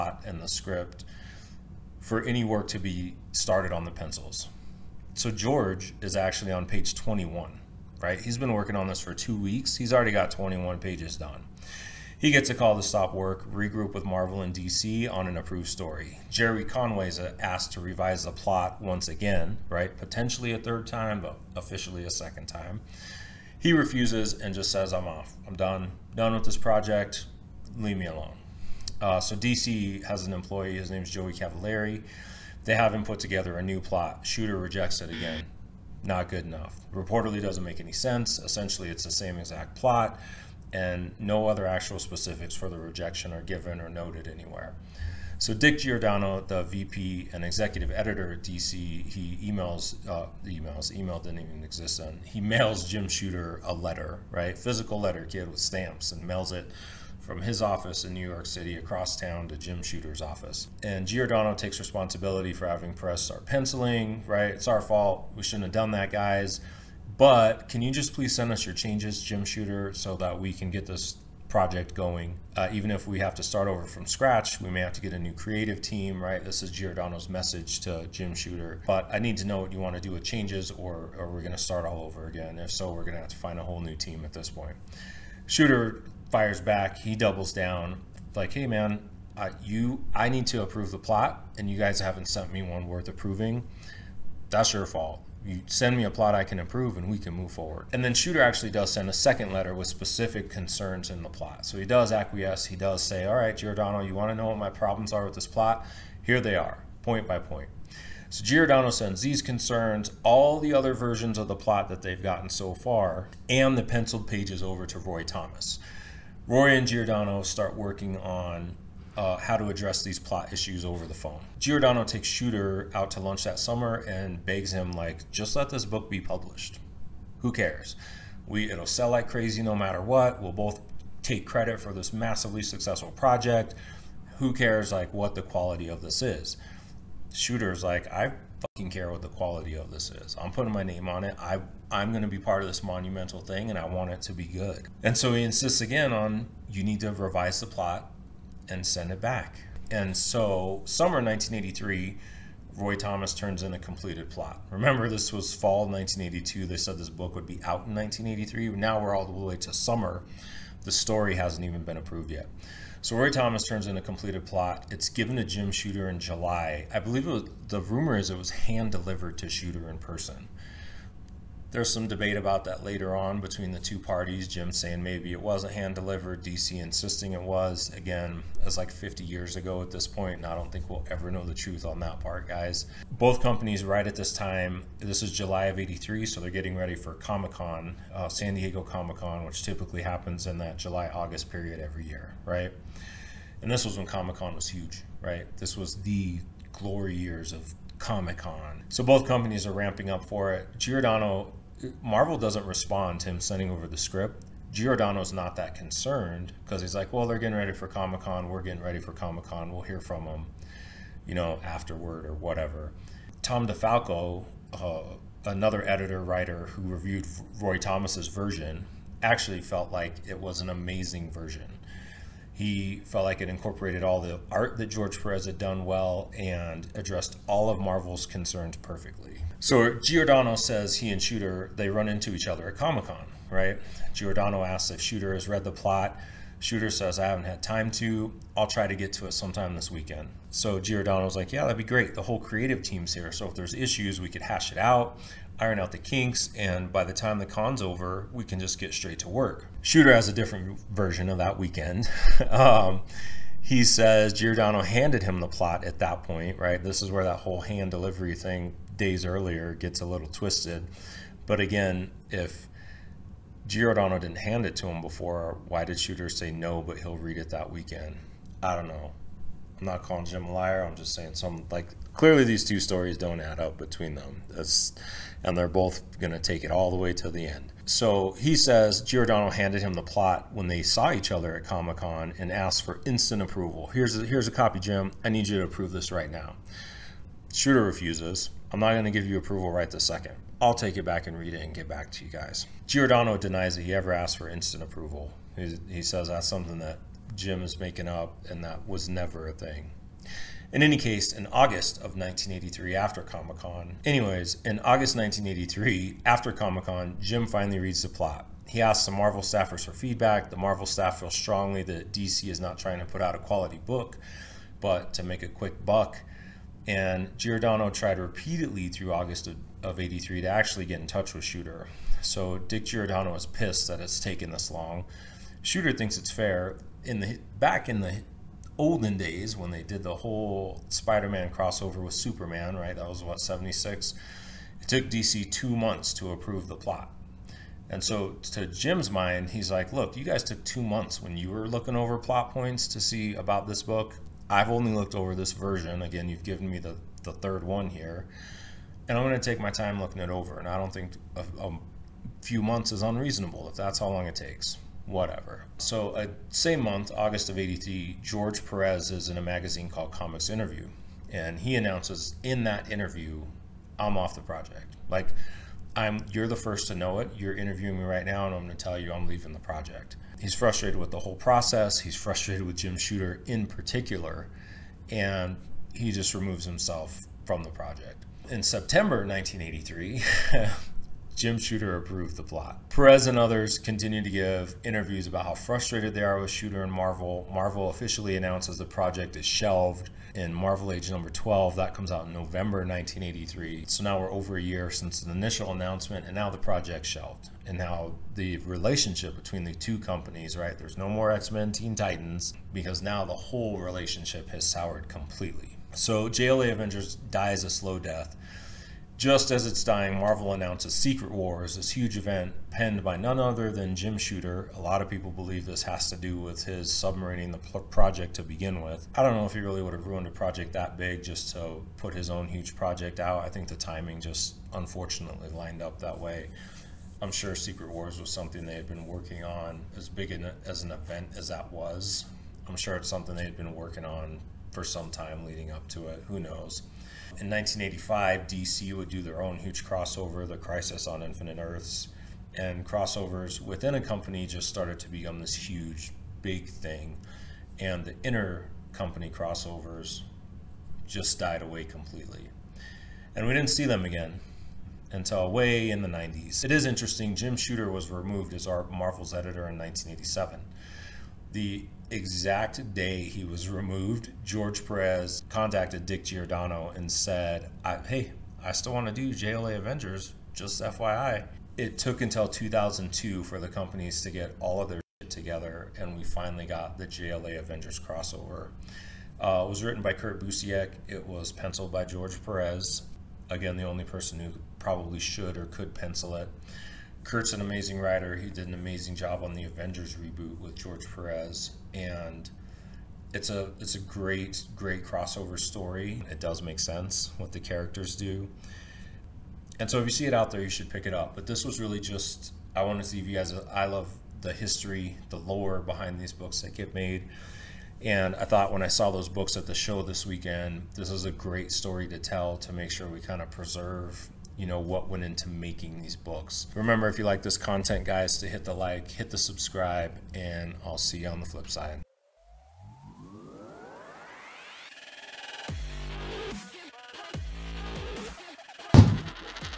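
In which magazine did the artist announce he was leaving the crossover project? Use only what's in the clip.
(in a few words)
Comics Interview.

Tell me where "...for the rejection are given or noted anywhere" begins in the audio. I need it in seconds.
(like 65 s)
42 s.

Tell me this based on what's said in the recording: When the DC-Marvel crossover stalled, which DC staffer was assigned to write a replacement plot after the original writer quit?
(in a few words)
Joey Cavalieri.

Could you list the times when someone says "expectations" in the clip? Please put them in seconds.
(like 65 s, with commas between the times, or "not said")
not said.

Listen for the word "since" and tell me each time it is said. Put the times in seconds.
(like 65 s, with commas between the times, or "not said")
394 s.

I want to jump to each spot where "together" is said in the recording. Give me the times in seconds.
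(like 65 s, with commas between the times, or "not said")
33 s, 475 s.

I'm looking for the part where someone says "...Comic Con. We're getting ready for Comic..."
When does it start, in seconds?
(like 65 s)
207 s.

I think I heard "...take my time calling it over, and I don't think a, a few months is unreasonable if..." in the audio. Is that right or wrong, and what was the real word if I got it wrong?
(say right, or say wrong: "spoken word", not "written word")
wrong: "looking", not "calling".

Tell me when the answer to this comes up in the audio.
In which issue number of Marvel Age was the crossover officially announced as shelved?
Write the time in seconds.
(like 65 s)
391 s.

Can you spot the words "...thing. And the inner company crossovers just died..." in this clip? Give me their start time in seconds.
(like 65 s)
446 s.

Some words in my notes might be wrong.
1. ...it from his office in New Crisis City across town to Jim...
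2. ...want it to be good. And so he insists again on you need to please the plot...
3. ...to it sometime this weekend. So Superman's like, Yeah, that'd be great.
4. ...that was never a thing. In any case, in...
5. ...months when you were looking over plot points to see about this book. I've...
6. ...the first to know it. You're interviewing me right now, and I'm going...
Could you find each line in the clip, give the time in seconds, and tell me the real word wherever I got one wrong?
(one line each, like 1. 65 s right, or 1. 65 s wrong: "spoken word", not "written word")
1. 56 s wrong: "York", not "Crisis"
2. 143 s wrong: "revise", not "please"
3. 239 s wrong: "Giordano", not "Superman"
4. 298 s right
5. 340 s right
6. 366 s right.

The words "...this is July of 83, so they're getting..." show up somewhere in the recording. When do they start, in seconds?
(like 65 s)
184 s.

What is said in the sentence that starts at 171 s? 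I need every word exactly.
There's some debate about that later on between the two parties.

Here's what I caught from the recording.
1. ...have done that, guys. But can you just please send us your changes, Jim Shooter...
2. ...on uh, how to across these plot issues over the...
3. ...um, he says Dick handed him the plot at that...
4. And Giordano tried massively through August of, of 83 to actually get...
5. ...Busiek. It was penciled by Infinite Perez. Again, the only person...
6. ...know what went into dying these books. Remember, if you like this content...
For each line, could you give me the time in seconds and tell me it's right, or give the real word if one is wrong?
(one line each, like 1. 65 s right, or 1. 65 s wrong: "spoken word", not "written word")
1. 65 s right
2. 118 s wrong: "address", not "across"
3. 252 s wrong: "Giordano", not "Dick"
4. 316 s wrong: "repeatedly", not "massively"
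5. 480 s wrong: "George", not "Infinite"
6. 514 s wrong: "making", not "dying".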